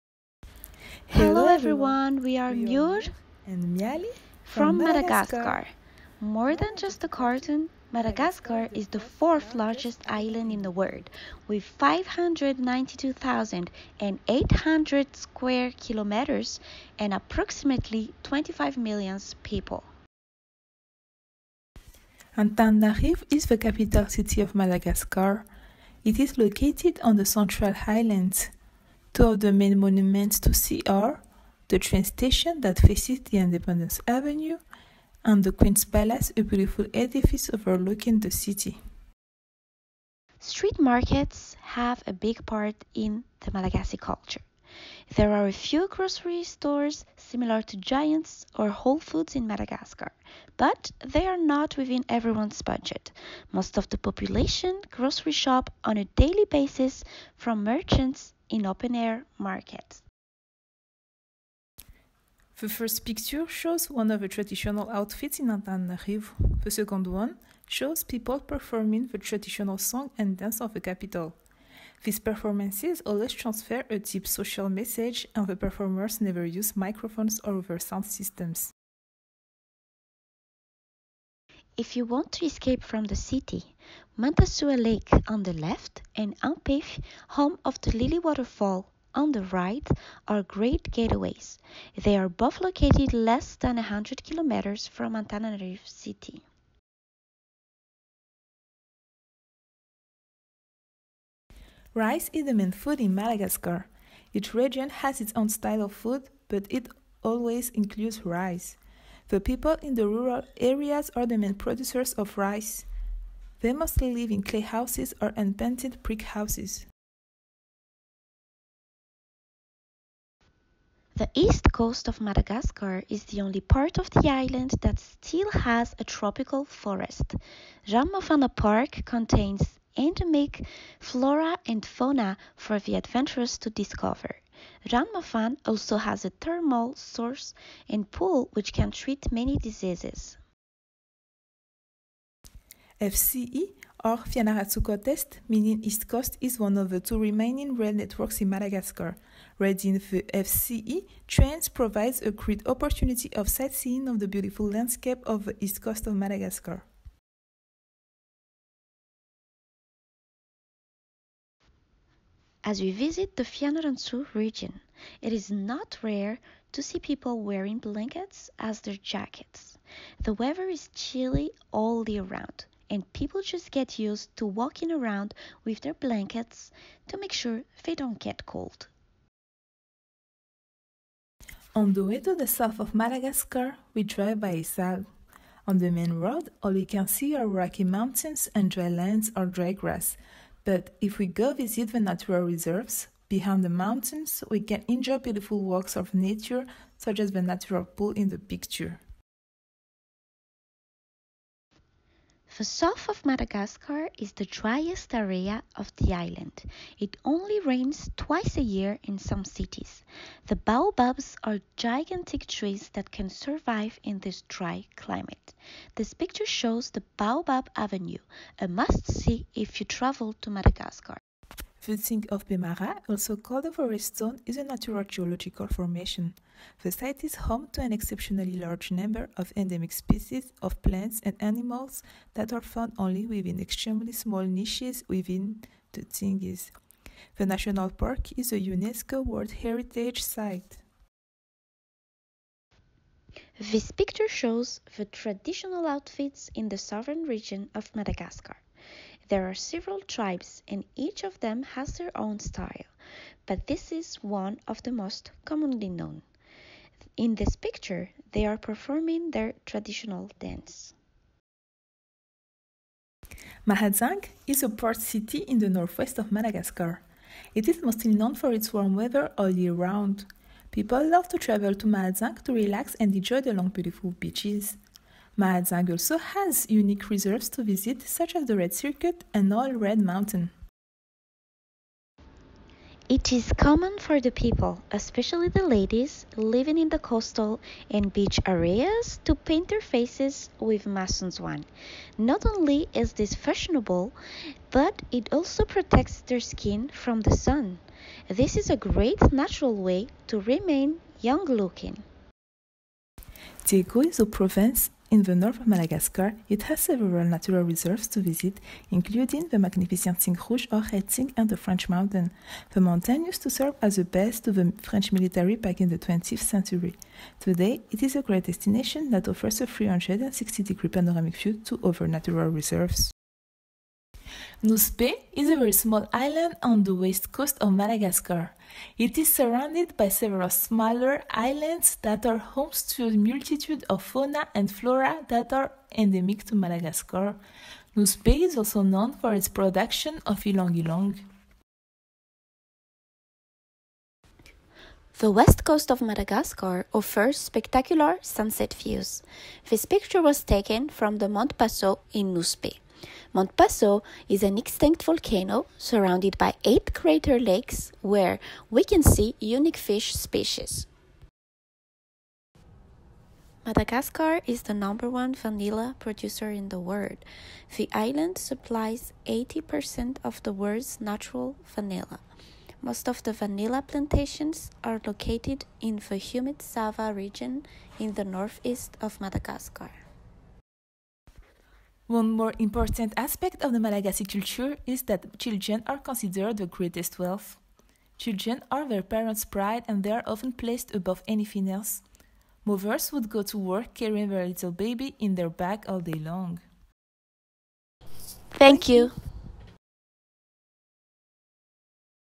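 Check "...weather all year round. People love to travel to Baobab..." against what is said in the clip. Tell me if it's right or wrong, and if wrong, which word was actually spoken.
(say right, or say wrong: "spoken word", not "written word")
wrong: "Mahajanga", not "Baobab".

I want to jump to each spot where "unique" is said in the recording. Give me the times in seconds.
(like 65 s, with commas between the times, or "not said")
276 s, 359 s.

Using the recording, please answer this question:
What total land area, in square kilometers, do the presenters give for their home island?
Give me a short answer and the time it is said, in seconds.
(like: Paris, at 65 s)
592,800 square kilometers, at 11 s.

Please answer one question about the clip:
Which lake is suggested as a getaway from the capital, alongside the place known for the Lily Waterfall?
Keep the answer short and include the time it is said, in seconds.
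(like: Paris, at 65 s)
Mantasoa Lake, at 84 s.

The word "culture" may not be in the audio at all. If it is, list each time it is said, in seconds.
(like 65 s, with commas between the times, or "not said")
43 s, 384 s.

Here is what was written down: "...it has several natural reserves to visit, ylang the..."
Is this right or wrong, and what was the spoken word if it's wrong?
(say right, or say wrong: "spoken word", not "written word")
wrong: "including", not "ylang".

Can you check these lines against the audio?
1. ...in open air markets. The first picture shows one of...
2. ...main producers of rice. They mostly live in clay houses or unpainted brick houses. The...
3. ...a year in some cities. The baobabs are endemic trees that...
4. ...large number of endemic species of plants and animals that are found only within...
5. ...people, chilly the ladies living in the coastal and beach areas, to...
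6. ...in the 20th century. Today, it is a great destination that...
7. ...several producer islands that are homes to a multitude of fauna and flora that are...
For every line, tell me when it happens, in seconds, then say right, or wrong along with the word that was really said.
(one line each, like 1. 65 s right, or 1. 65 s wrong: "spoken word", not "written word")
1. 58 s right
2. 111 s right
3. 208 s wrong: "gigantic", not "endemic"
4. 228 s right
5. 284 s wrong: "especially", not "chilly"
6. 315 s right
7. 330 s wrong: "smaller", not "producer".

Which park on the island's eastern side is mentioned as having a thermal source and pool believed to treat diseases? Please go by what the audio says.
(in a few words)
Ranomafana Park.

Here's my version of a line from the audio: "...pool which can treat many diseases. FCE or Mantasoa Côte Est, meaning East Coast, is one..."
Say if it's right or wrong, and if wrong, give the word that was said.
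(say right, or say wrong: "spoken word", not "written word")
wrong: "Fianarantsoa", not "Mantasoa".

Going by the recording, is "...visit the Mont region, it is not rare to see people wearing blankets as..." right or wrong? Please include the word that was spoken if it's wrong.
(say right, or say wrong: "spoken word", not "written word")
wrong: "Fianarantsoa", not "Mont".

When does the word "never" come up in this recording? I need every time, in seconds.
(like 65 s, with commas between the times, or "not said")
76 s.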